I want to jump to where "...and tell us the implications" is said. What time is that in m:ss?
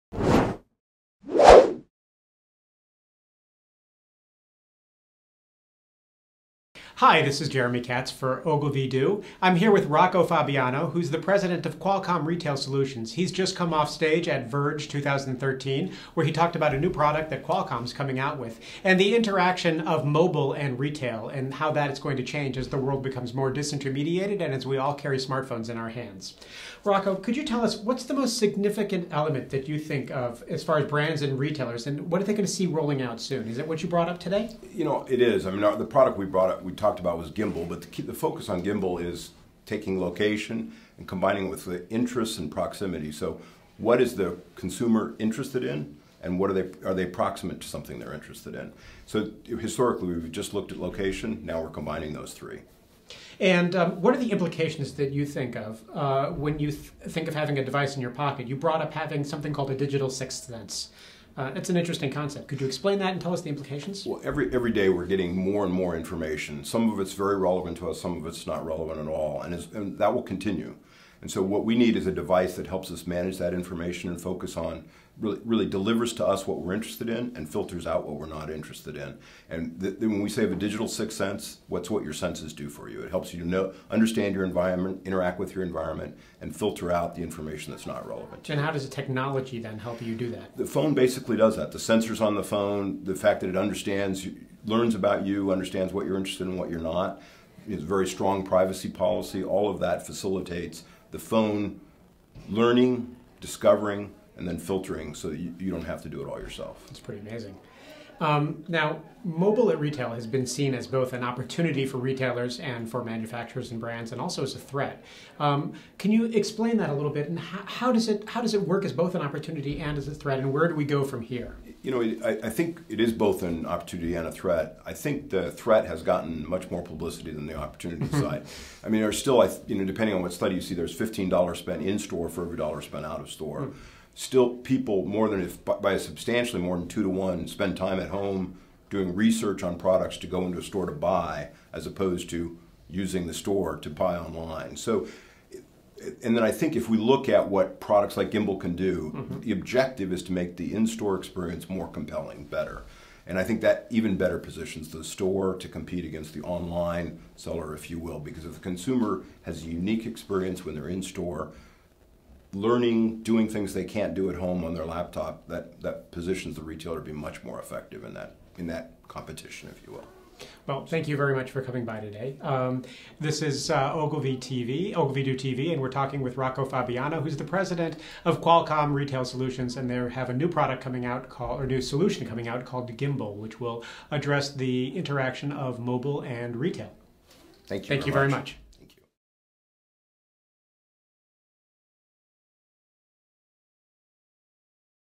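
1:03.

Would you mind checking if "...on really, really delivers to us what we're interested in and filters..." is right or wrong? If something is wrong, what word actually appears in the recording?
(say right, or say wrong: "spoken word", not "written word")
right.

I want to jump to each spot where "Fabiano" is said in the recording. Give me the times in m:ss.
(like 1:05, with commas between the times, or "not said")
0:10, 2:56.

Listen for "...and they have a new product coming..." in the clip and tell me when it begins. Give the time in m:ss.
2:59.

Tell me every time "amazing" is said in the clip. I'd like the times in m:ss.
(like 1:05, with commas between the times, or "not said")
1:47.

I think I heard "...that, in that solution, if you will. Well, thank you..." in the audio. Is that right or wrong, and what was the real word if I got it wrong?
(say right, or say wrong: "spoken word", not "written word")
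wrong: "competition", not "solution".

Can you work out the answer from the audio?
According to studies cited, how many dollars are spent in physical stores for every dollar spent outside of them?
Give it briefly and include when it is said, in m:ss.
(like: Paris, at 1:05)
15, at 2:10.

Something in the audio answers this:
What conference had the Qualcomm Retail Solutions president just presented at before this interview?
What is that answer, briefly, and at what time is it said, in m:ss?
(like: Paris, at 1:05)
Verge 2013, at 0:14.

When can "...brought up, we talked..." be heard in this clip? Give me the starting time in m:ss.
0:36.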